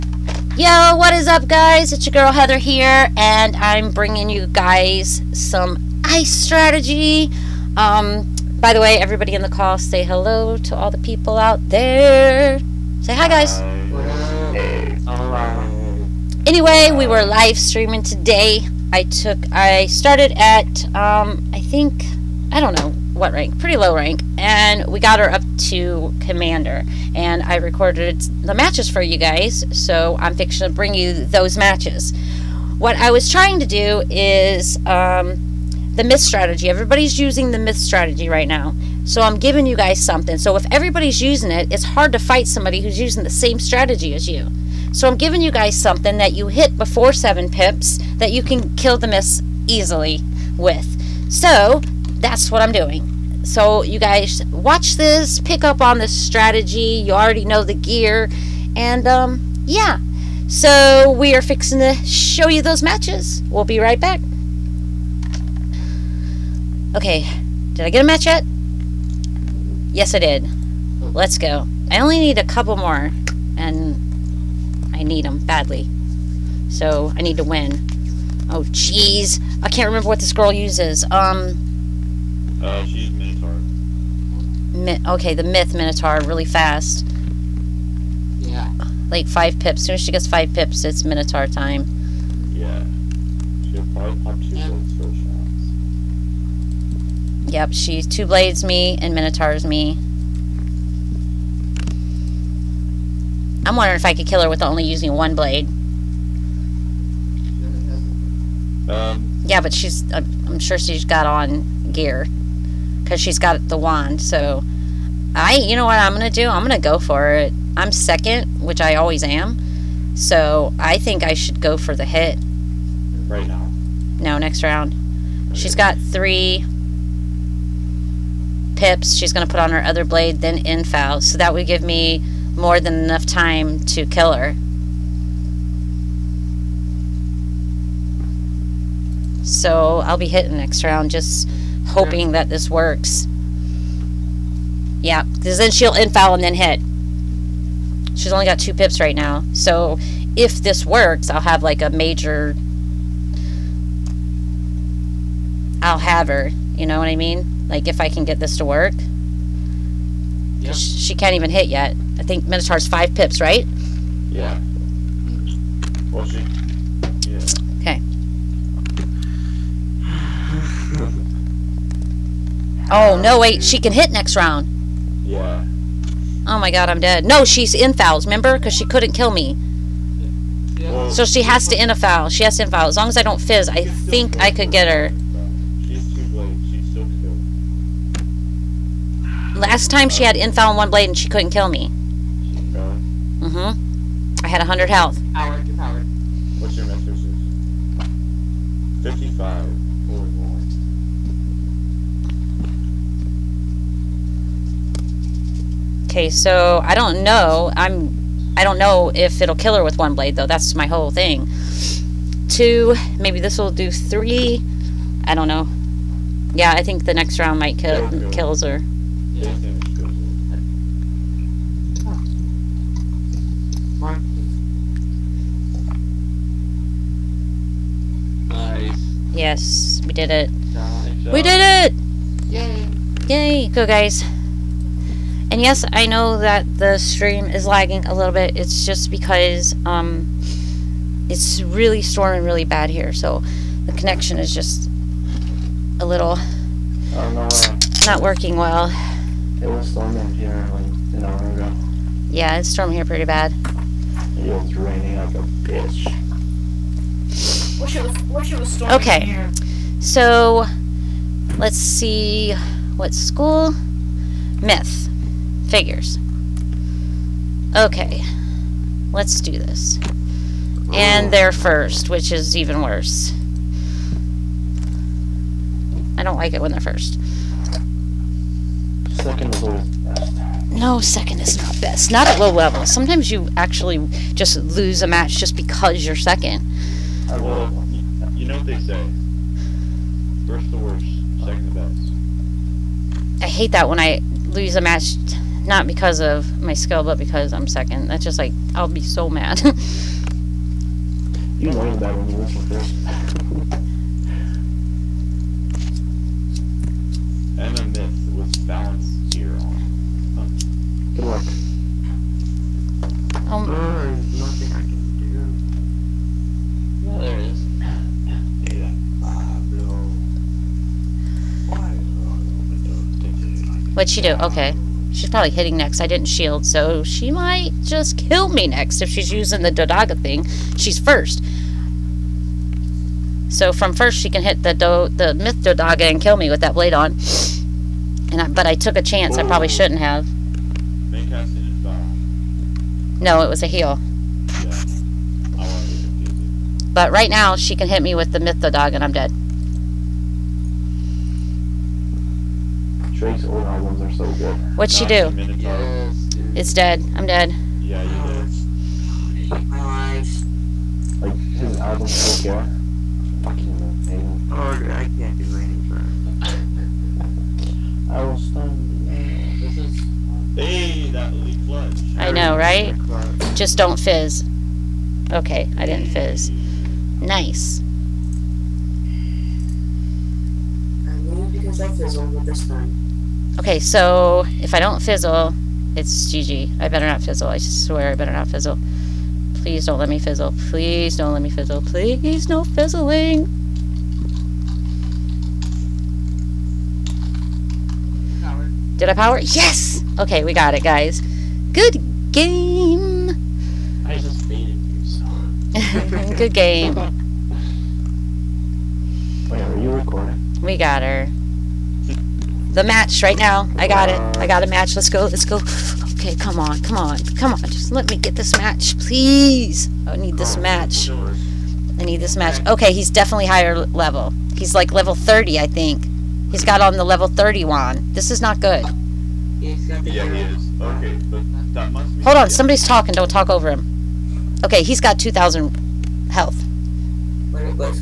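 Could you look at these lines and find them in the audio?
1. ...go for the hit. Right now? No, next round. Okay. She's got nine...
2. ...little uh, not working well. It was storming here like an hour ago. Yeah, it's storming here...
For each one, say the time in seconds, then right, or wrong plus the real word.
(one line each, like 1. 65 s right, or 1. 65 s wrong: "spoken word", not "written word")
1. 121 s wrong: "three", not "nine"
2. 246 s right.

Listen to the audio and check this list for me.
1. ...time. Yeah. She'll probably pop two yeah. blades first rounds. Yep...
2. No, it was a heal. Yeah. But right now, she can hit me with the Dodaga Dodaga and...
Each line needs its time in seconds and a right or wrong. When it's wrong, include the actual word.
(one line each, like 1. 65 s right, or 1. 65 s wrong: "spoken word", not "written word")
1. 91 s right
2. 343 s wrong: "Myth", not "Dodaga".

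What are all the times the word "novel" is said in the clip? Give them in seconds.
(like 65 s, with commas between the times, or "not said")
not said.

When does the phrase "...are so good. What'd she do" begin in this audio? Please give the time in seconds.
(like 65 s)
354 s.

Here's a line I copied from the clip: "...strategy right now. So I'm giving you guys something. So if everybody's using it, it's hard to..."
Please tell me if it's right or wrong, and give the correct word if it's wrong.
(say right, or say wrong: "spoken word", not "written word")
right.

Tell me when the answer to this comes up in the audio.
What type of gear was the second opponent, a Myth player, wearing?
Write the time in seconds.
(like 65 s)
308 s.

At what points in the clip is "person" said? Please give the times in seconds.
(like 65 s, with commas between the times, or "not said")
not said.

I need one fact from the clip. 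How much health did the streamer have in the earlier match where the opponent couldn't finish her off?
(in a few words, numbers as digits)
100.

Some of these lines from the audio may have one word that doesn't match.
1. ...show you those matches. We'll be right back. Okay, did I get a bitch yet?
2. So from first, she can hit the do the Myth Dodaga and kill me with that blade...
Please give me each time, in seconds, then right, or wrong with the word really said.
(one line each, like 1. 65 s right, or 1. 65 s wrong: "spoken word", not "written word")
1. 62 s wrong: "match", not "bitch"
2. 333 s right.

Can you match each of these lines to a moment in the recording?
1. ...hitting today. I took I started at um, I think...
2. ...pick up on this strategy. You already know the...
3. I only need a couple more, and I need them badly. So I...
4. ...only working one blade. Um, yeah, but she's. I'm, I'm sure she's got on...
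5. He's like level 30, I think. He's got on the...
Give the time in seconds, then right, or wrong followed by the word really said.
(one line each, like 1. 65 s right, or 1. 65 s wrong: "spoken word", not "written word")
1. 17 s wrong: "streaming", not "hitting"
2. 55 s right
3. 71 s right
4. 104 s wrong: "using", not "working"
5. 424 s right.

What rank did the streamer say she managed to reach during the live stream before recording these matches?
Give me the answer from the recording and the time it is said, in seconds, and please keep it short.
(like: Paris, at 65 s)
Commander, at 26 s.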